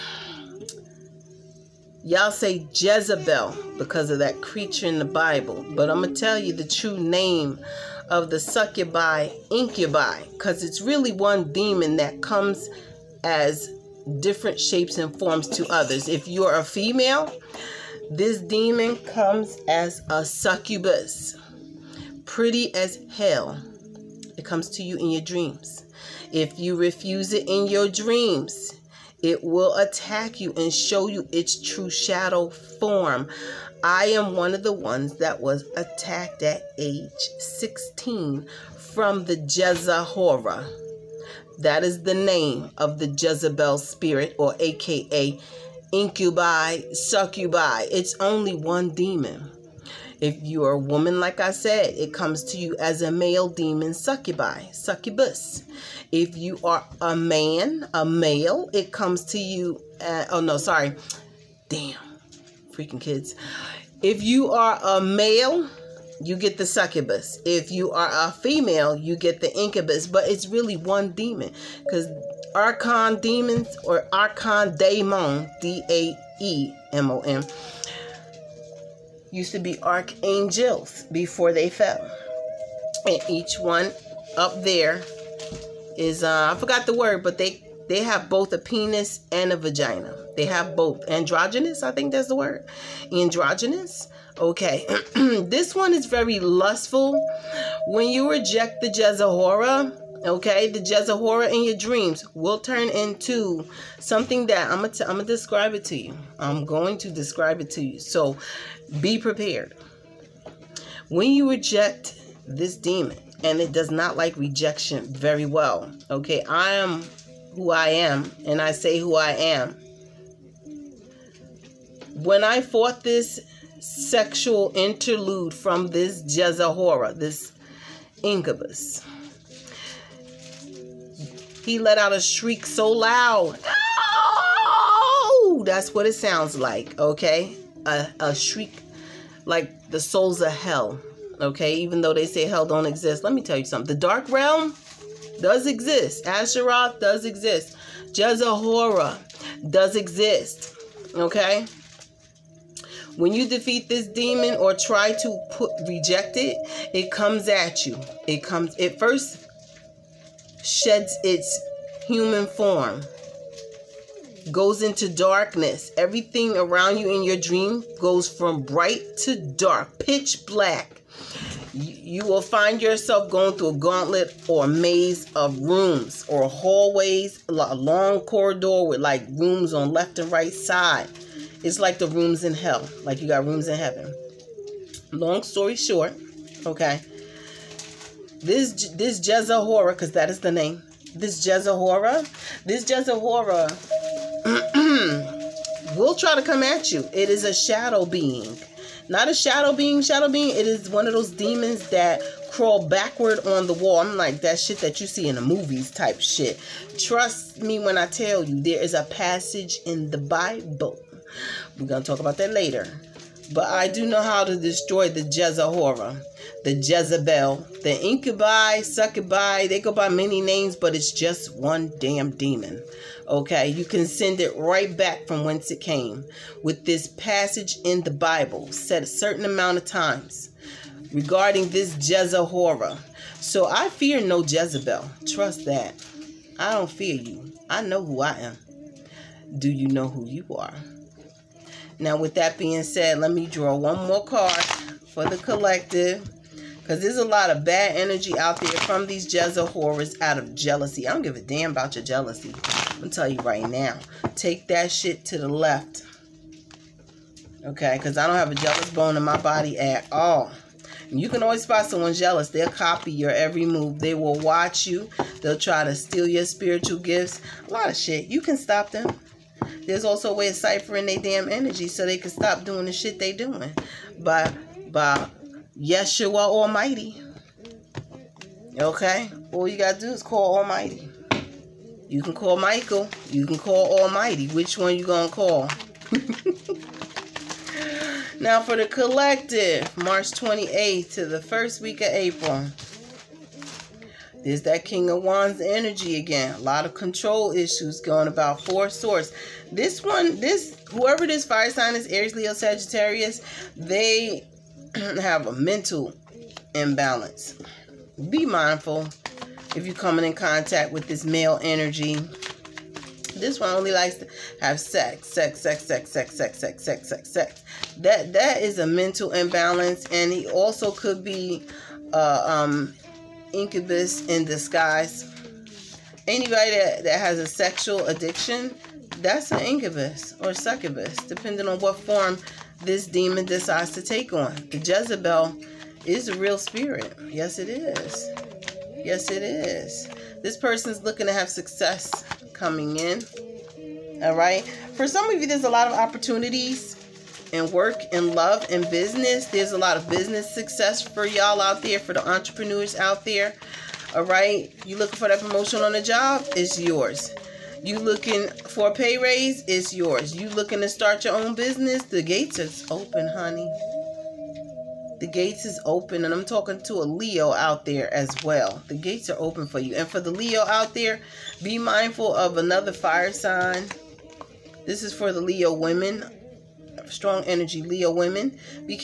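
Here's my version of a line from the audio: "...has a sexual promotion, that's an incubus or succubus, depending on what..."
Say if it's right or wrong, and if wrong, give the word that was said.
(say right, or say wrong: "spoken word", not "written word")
wrong: "addiction", not "promotion".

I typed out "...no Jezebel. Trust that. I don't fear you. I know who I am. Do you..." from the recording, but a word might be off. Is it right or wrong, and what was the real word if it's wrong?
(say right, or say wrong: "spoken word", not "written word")
right.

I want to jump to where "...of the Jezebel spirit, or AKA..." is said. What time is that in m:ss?
0:42.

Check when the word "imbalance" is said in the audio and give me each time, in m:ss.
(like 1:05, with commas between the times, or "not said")
5:06, 5:19.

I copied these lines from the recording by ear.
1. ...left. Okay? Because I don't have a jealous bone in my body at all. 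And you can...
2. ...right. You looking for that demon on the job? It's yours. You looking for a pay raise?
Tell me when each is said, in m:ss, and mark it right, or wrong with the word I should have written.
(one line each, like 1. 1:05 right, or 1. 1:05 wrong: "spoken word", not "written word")
1. 4:15 right
2. 5:54 wrong: "promotion", not "demon".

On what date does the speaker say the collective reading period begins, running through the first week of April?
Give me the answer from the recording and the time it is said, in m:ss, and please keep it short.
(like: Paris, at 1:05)
March 28, at 4:49.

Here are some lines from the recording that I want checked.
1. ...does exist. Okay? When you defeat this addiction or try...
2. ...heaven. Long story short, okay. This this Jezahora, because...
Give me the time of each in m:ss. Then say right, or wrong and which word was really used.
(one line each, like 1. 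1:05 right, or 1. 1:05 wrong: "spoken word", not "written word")
1. 2:29 wrong: "demon", not "addiction"
2. 3:03 right.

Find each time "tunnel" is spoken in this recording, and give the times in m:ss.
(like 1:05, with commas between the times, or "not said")
not said.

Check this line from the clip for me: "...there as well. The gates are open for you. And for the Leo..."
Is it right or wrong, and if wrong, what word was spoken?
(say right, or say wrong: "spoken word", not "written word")
right.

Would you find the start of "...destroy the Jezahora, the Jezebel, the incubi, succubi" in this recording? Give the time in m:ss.
3:34.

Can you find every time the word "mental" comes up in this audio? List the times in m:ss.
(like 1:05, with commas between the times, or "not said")
5:05, 5:18.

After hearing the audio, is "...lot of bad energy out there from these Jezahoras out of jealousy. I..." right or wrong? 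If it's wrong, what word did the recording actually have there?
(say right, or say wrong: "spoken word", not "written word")
right.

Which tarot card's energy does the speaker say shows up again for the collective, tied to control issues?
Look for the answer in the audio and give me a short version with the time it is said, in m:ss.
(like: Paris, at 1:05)
King of Wands, at 4:54.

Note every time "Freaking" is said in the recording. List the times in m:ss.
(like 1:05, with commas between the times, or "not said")
1:02.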